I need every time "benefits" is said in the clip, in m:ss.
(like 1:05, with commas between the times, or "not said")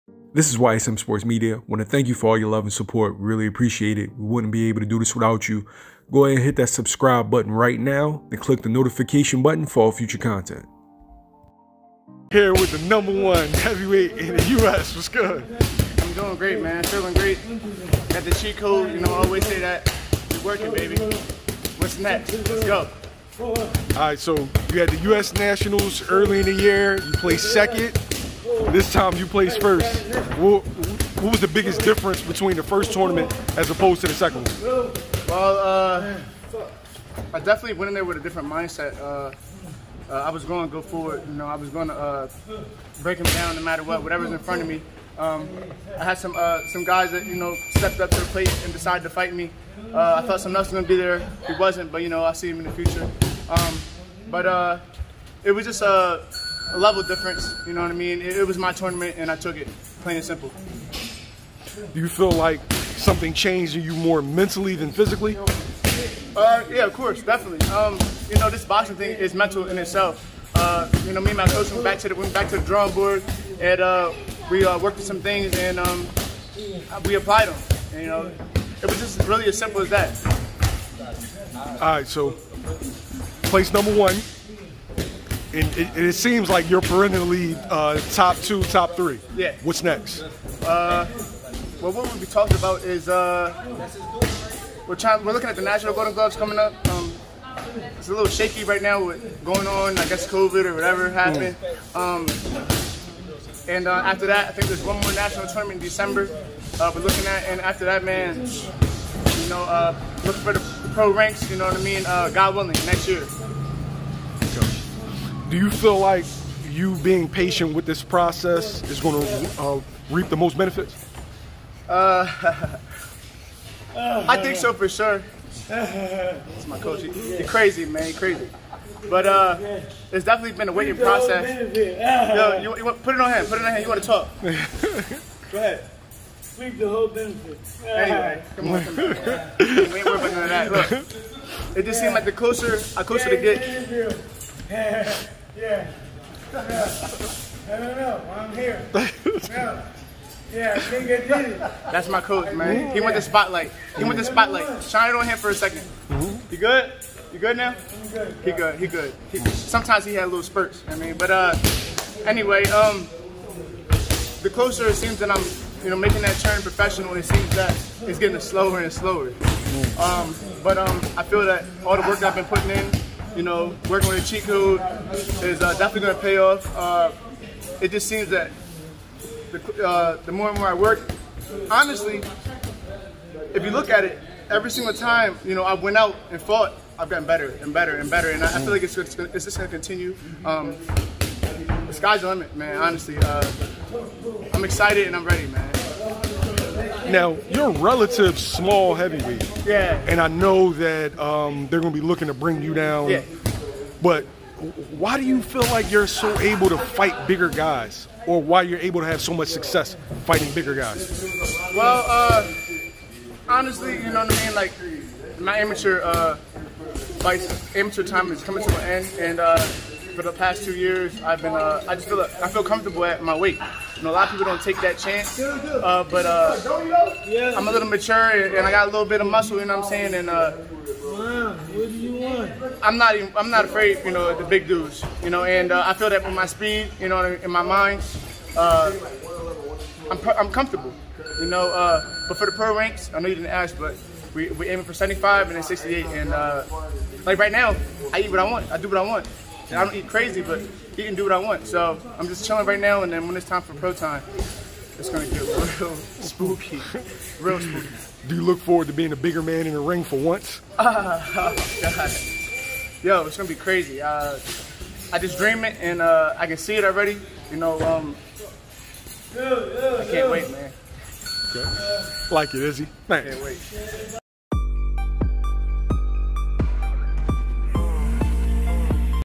2:00, 2:17.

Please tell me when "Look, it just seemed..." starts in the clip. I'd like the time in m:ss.
2:20.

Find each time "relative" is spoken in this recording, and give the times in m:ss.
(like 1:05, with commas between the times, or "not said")
3:17.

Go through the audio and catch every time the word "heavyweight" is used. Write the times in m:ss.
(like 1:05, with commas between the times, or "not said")
0:13, 3:18.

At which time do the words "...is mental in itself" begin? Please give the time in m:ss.
1:09.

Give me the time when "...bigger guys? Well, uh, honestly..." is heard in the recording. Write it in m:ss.
3:30.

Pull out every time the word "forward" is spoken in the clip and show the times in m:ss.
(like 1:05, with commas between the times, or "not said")
0:40, 4:18.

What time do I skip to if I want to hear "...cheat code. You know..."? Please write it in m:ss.
0:18.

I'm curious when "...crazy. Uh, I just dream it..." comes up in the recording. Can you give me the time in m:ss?
4:23.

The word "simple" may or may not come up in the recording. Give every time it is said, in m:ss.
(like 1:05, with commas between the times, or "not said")
1:00, 1:19.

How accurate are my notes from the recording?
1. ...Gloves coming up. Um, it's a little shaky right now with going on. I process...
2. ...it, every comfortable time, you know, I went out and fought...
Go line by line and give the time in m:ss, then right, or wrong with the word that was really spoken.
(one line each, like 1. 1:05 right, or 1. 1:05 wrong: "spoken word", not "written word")
1. 1:36 wrong: "guess", not "process"
2. 3:04 wrong: "single", not "comfortable".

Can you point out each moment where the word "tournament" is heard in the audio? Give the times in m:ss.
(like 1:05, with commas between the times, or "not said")
0:32, 0:58, 1:45.